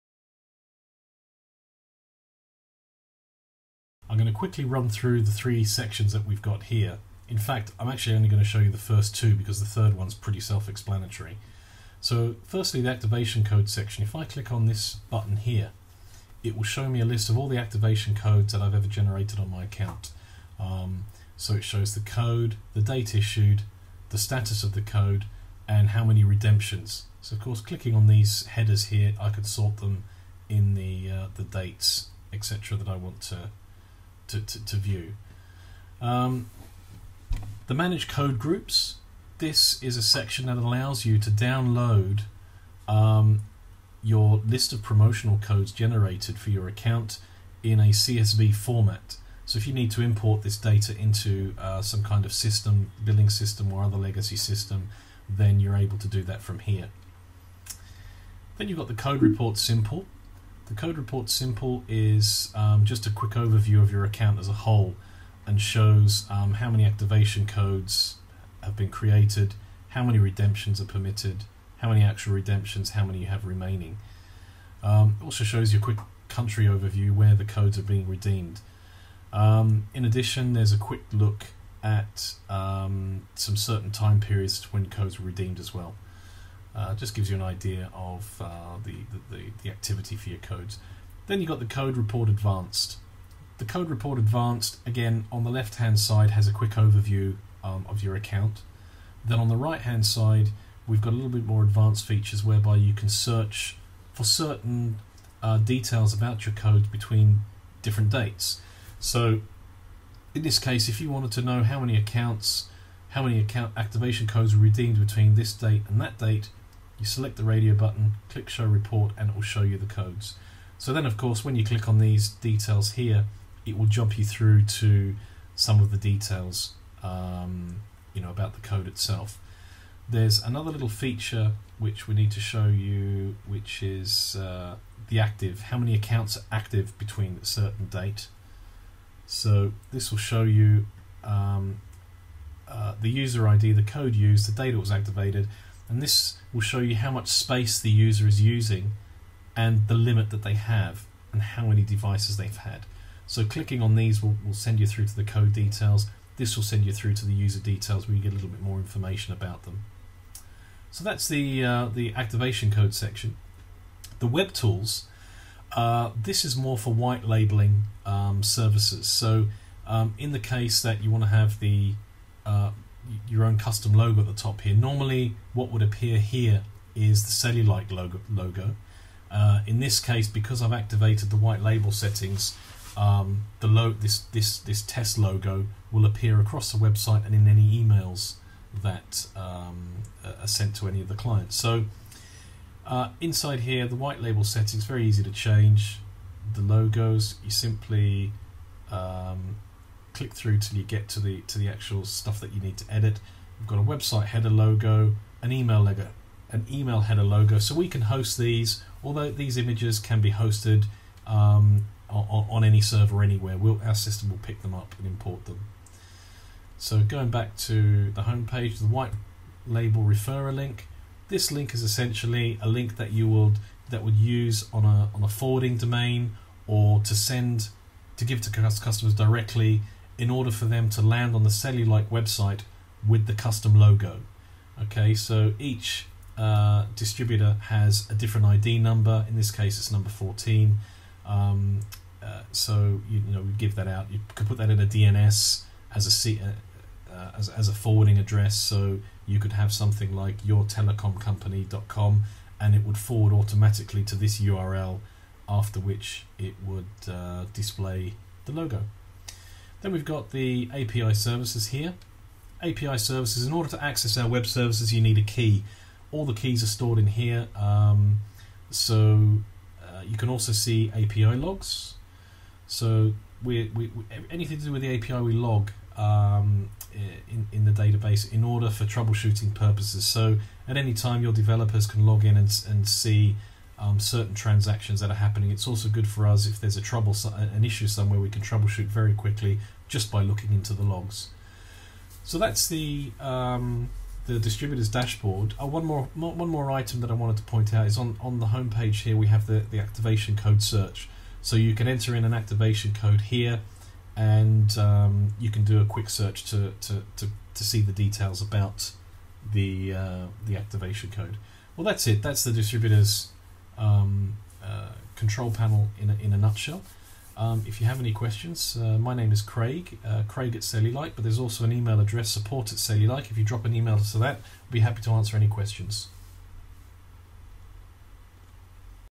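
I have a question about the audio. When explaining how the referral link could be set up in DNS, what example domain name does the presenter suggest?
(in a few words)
yourtelecomcompany.com.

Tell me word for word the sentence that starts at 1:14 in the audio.
Um, also shows you a quick country overview where the codes are being redeemed.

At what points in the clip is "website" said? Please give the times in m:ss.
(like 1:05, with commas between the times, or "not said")
3:06, 3:23, 3:52.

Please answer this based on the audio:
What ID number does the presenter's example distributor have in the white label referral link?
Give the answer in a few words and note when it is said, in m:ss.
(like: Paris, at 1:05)
14, at 3:59.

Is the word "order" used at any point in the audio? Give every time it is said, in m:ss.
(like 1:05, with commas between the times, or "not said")
3:50, 4:23, 4:38.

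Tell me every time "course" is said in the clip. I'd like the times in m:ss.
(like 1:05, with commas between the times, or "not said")
0:27, 2:01.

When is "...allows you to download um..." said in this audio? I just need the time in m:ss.
0:40.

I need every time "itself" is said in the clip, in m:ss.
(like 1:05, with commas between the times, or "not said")
2:08.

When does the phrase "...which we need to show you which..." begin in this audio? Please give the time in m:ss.
2:11.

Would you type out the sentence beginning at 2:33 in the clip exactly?
So clicking on these will, will send you through to the code details.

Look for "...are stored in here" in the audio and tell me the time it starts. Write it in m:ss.
4:26.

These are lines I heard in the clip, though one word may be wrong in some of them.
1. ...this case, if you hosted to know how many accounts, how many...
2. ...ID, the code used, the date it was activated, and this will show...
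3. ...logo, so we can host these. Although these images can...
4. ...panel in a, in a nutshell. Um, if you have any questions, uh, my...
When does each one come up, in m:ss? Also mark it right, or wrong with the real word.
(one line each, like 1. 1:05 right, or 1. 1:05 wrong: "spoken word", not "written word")
1. 1:50 wrong: "wanted", not "hosted"
2. 2:23 right
3. 3:27 right
4. 5:15 right.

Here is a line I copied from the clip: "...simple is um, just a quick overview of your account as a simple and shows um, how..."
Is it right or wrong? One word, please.
wrong.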